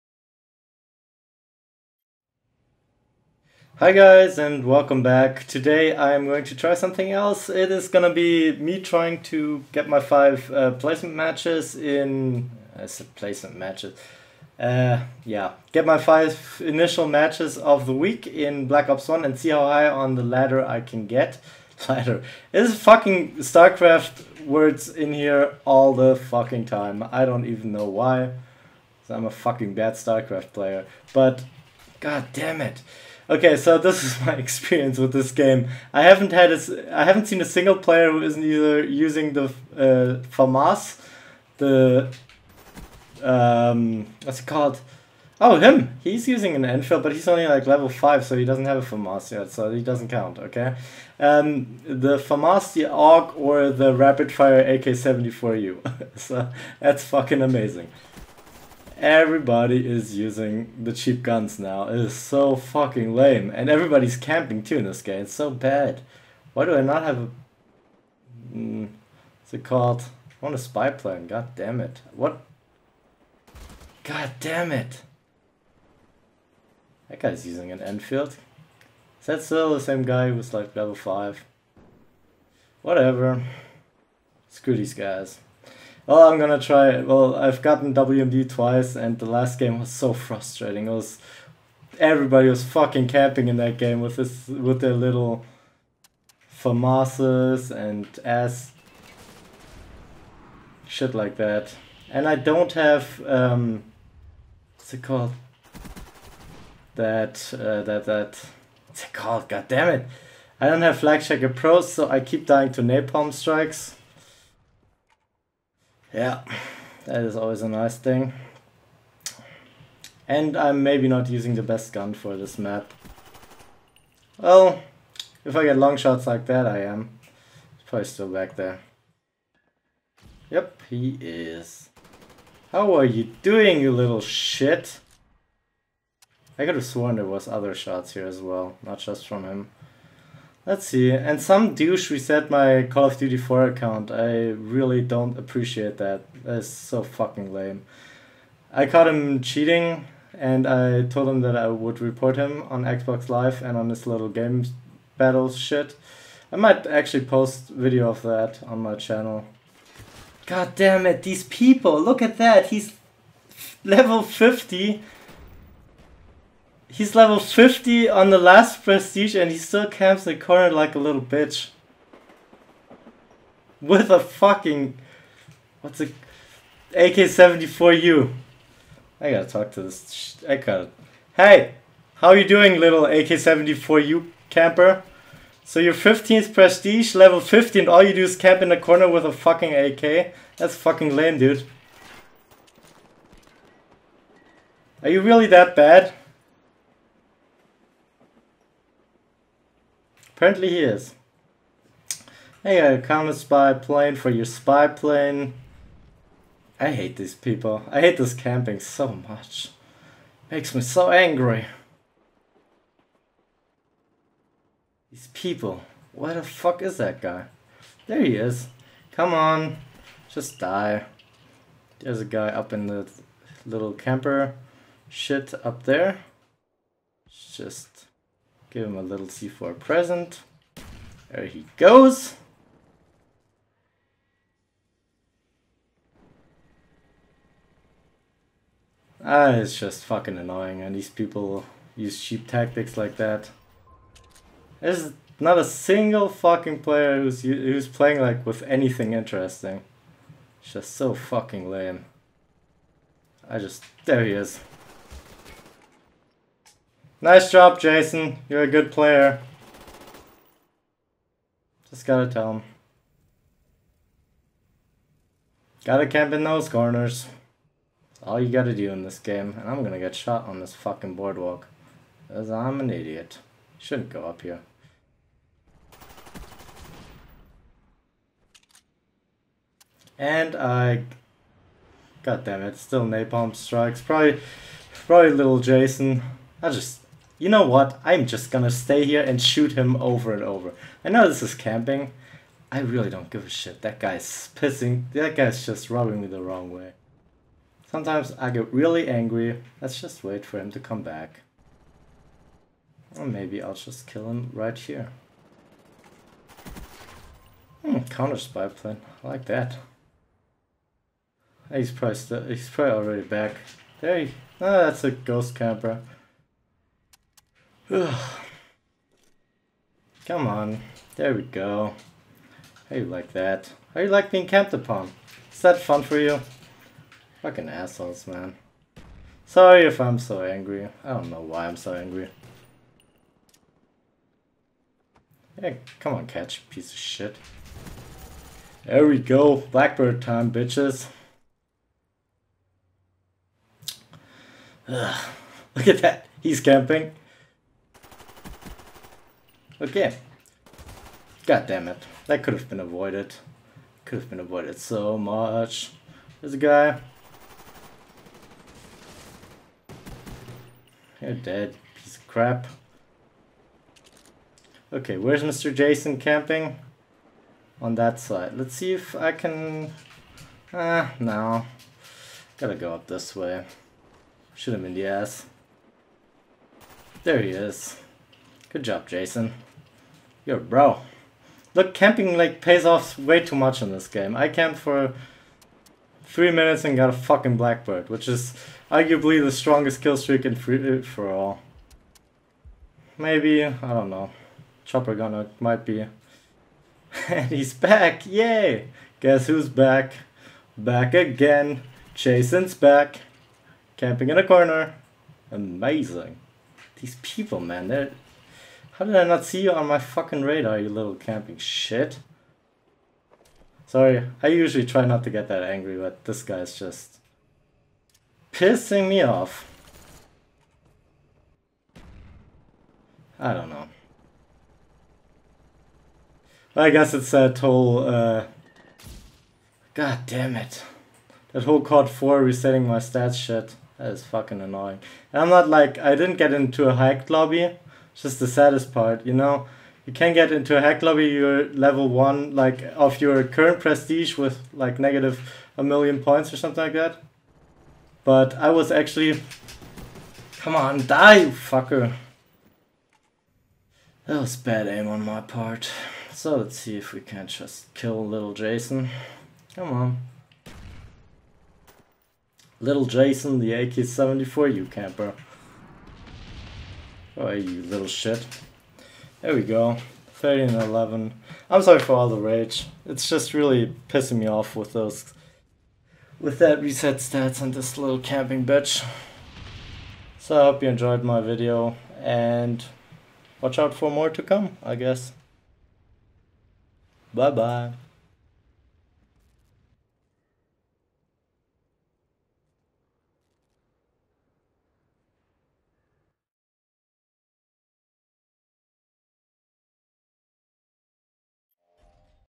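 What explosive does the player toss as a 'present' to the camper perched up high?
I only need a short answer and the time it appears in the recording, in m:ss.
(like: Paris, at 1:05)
C4, at 3:49.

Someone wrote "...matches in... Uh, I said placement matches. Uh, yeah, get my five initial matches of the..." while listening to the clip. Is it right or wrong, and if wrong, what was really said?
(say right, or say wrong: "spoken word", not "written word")
right.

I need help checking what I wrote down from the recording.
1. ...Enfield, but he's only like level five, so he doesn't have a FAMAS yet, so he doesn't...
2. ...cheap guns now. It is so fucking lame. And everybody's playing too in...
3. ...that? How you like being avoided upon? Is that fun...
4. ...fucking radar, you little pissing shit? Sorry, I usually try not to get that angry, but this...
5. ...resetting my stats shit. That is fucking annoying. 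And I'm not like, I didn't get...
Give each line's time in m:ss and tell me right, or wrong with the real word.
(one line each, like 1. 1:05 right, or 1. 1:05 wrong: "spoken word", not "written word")
1. 0:46 right
2. 1:00 wrong: "camping", not "playing"
3. 5:23 wrong: "camped", not "avoided"
4. 6:49 wrong: "camping", not "pissing"
5. 7:12 right.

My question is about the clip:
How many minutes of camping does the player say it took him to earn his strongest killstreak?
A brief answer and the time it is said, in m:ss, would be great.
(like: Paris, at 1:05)
3, at 6:26.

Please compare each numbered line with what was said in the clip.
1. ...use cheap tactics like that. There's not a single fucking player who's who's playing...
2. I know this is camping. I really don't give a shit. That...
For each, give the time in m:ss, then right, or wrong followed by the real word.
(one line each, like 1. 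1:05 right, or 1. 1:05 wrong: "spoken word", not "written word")
1. 4:01 right
2. 4:51 right.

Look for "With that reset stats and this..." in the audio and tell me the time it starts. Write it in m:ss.
7:56.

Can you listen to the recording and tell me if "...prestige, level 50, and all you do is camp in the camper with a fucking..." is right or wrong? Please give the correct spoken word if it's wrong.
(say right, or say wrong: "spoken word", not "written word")
wrong: "corner", not "camper".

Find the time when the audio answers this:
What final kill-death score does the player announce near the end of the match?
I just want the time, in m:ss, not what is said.
7:50.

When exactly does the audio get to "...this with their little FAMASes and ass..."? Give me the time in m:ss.
1:34.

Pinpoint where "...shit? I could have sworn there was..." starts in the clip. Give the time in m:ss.
2:14.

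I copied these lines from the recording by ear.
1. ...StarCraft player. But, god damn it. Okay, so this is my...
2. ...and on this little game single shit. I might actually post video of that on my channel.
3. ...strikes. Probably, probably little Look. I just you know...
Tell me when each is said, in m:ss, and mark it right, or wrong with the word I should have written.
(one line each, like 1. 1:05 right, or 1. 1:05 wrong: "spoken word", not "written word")
1. 0:29 right
2. 2:33 wrong: "battle", not "single"
3. 4:43 wrong: "Jason", not "Look".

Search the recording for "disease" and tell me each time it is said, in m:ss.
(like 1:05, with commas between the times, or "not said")
not said.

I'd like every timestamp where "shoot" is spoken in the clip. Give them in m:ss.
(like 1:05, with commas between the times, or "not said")
4:49, 6:14.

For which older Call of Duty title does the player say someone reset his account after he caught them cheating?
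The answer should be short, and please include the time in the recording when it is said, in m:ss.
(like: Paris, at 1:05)
Call of Duty 4, at 2:22.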